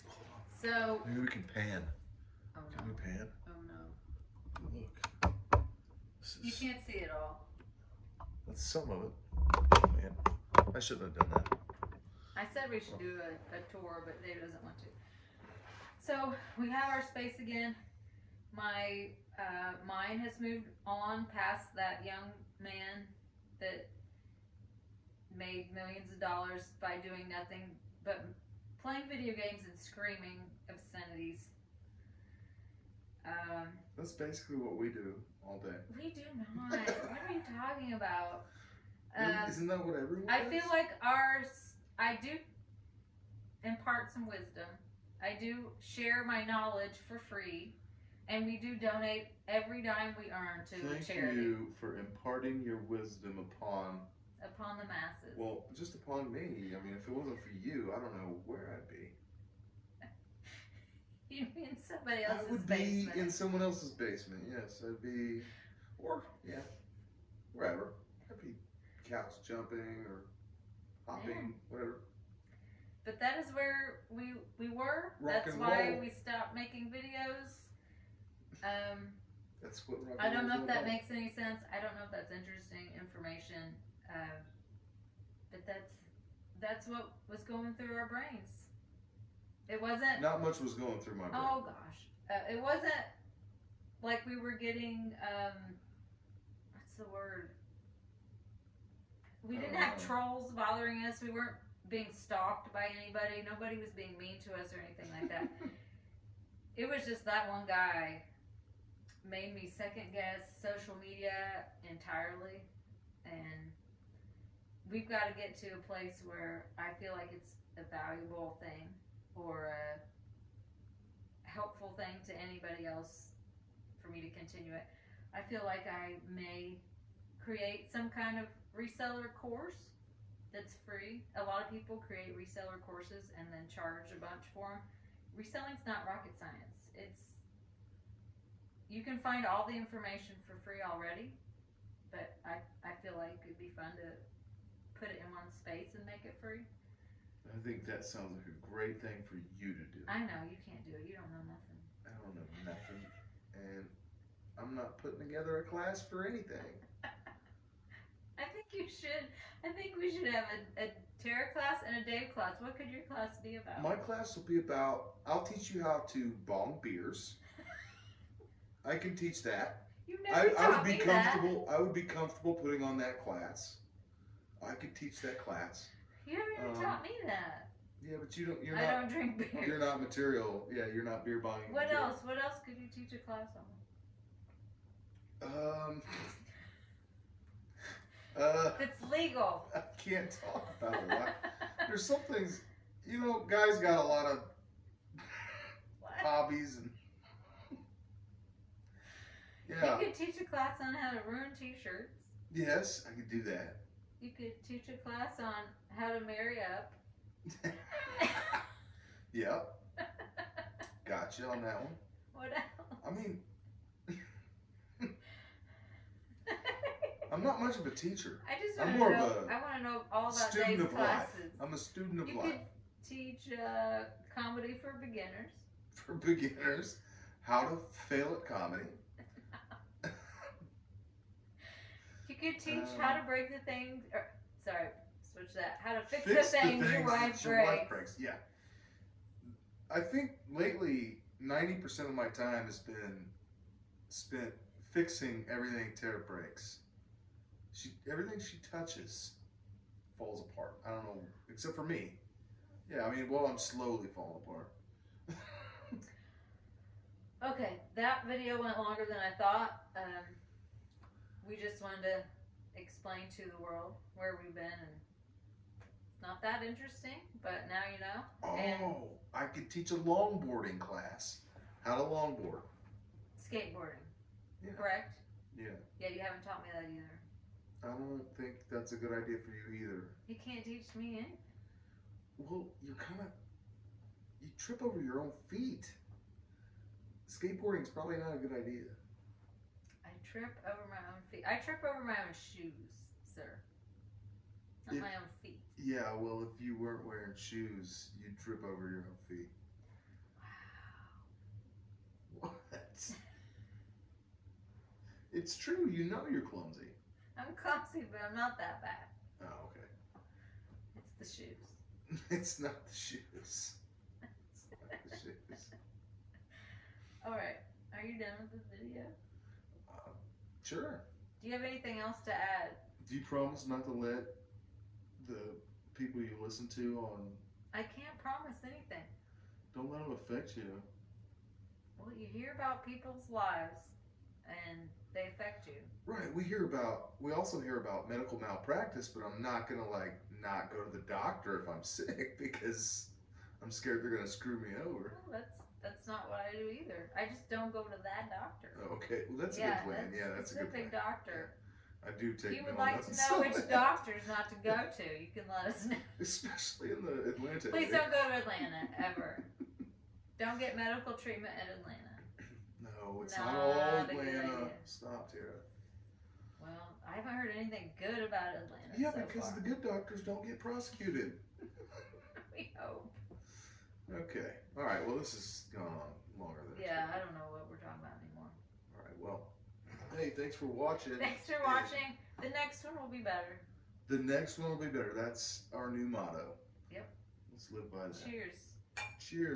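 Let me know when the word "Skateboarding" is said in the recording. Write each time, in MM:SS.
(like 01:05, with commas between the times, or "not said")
04:33, 04:47.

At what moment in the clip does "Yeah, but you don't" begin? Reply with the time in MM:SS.
02:58.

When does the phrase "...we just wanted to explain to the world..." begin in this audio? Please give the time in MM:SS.
04:21.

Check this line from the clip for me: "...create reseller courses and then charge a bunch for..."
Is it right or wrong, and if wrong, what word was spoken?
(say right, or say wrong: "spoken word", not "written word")
right.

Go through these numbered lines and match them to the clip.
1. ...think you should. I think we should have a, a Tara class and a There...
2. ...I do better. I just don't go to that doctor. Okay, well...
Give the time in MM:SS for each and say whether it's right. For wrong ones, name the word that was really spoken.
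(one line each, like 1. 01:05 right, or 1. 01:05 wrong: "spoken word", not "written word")
1. 02:38 wrong: "Dave", not "There"
2. 05:46 wrong: "either", not "better".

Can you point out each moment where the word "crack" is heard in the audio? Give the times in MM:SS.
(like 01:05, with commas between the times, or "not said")
not said.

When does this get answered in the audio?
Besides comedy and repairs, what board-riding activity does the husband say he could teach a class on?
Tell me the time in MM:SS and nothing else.
04:29.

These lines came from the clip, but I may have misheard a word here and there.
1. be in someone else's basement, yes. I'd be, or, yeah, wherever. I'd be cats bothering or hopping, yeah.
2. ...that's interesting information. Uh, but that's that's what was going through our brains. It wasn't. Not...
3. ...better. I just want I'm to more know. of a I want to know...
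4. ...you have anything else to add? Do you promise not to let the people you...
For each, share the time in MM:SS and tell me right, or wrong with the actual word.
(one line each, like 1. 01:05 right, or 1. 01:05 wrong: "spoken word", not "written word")
1. 01:03 wrong: "jumping", not "bothering"
2. 01:22 right
3. 03:37 wrong: "teacher", not "better"
4. 05:21 right.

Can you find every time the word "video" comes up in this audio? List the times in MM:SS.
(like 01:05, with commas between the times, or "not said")
00:29, 01:16, 04:18, 05:18.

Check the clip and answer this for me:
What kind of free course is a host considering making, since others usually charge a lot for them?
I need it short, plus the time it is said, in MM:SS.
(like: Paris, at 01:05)
Reseller course, at 02:08.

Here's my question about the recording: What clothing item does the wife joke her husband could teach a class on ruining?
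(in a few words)
T-shirts.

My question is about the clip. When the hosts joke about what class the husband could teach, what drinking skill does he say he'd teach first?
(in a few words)
How to bong beers.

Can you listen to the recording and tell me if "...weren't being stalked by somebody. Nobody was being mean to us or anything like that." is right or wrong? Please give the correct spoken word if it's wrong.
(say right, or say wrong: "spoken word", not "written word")
wrong: "anybody", not "somebody".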